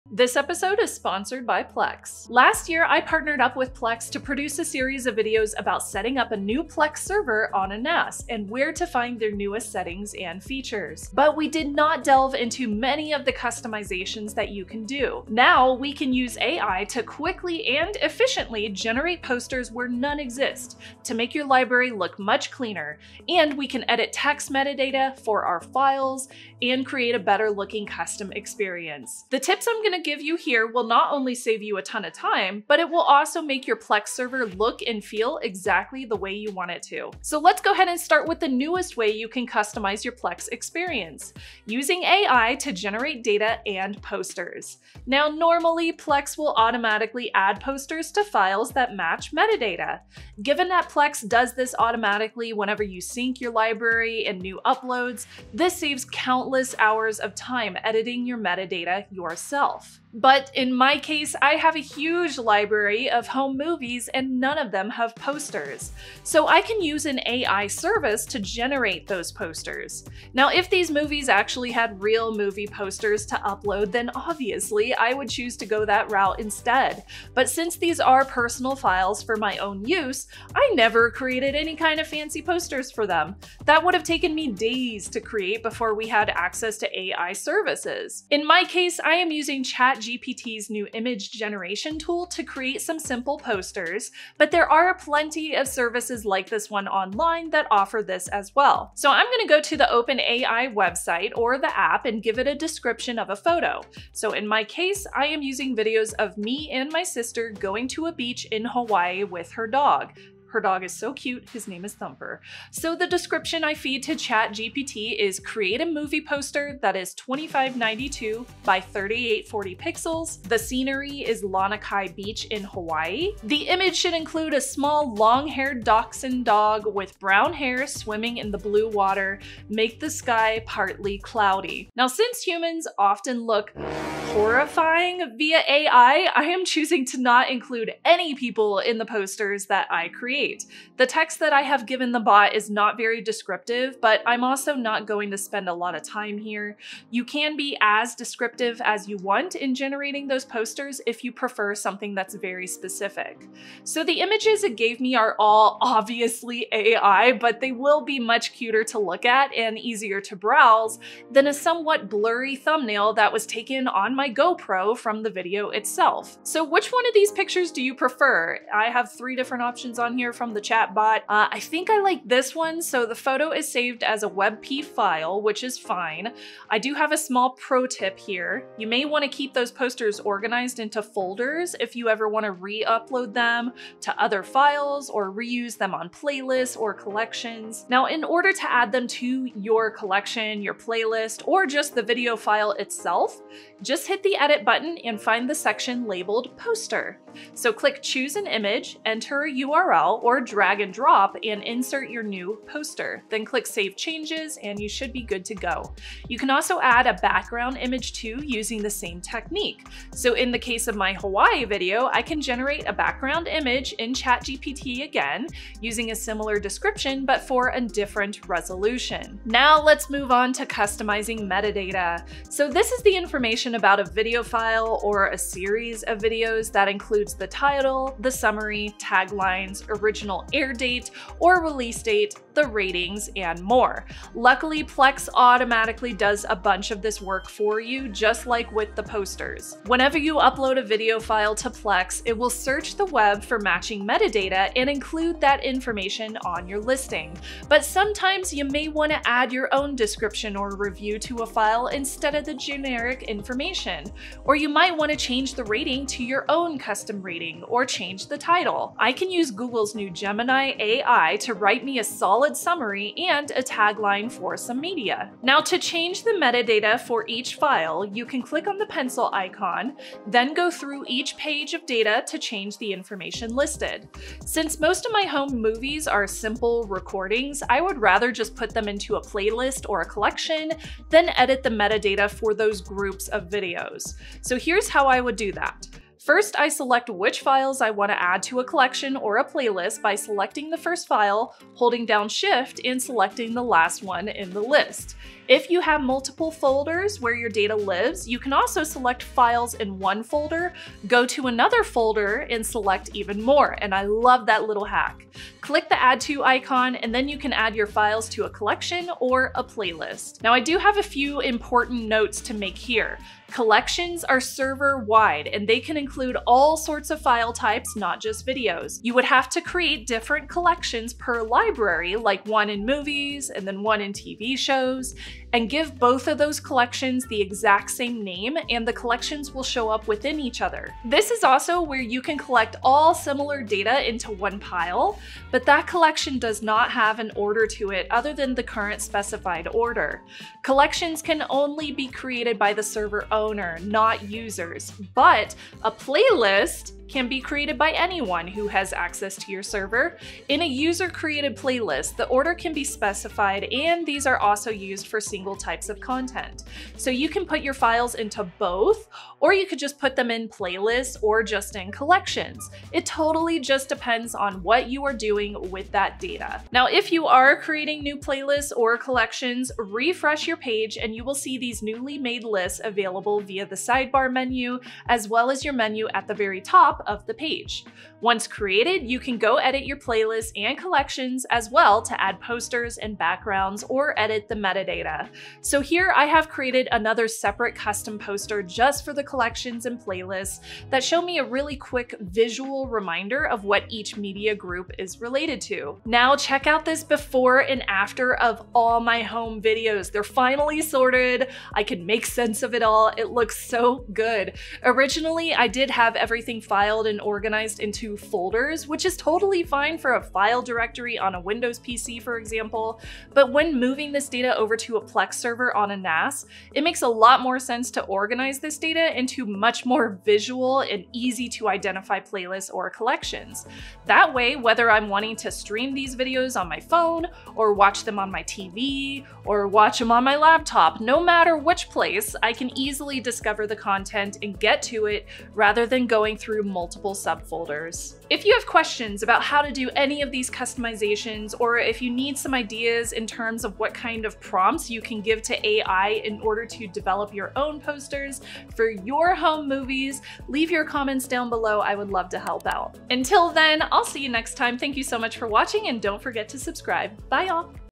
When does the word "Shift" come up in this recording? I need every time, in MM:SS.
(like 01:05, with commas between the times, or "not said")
04:52.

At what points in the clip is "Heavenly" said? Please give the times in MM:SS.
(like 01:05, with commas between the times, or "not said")
not said.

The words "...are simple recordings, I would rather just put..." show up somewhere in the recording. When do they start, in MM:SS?
04:36.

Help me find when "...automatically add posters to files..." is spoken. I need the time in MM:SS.
00:46.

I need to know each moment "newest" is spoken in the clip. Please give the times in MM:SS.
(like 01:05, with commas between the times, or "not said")
00:09, 00:38.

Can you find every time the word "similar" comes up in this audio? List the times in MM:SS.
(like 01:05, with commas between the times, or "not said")
03:36, 05:33.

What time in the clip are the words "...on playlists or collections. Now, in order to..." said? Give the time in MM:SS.
03:05.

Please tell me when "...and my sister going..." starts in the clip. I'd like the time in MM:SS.
01:46.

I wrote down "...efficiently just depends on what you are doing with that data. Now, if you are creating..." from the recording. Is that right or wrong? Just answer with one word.
wrong.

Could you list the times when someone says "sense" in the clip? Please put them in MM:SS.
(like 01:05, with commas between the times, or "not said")
06:42, 06:57.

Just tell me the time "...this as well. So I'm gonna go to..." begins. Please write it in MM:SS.
01:38.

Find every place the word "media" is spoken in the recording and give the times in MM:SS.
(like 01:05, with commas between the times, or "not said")
04:24, 06:34.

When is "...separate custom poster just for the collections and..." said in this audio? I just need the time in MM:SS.
06:27.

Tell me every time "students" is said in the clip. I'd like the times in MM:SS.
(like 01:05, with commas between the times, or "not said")
not said.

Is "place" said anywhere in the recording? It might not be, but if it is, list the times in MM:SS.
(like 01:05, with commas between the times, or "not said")
07:11.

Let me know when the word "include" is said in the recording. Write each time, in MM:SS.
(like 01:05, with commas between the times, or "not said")
02:04, 02:17, 03:46, 04:04, 05:15.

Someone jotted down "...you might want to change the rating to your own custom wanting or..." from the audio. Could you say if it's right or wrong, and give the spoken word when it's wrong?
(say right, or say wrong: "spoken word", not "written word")
wrong: "rating", not "wanting".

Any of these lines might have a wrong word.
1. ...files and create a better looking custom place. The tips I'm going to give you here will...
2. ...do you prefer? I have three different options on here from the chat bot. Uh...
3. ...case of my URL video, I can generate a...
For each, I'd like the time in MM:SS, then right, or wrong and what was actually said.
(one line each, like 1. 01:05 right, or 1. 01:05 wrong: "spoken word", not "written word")
1. 00:25 wrong: "experience", not "place"
2. 02:47 right
3. 03:30 wrong: "Hawaii", not "URL".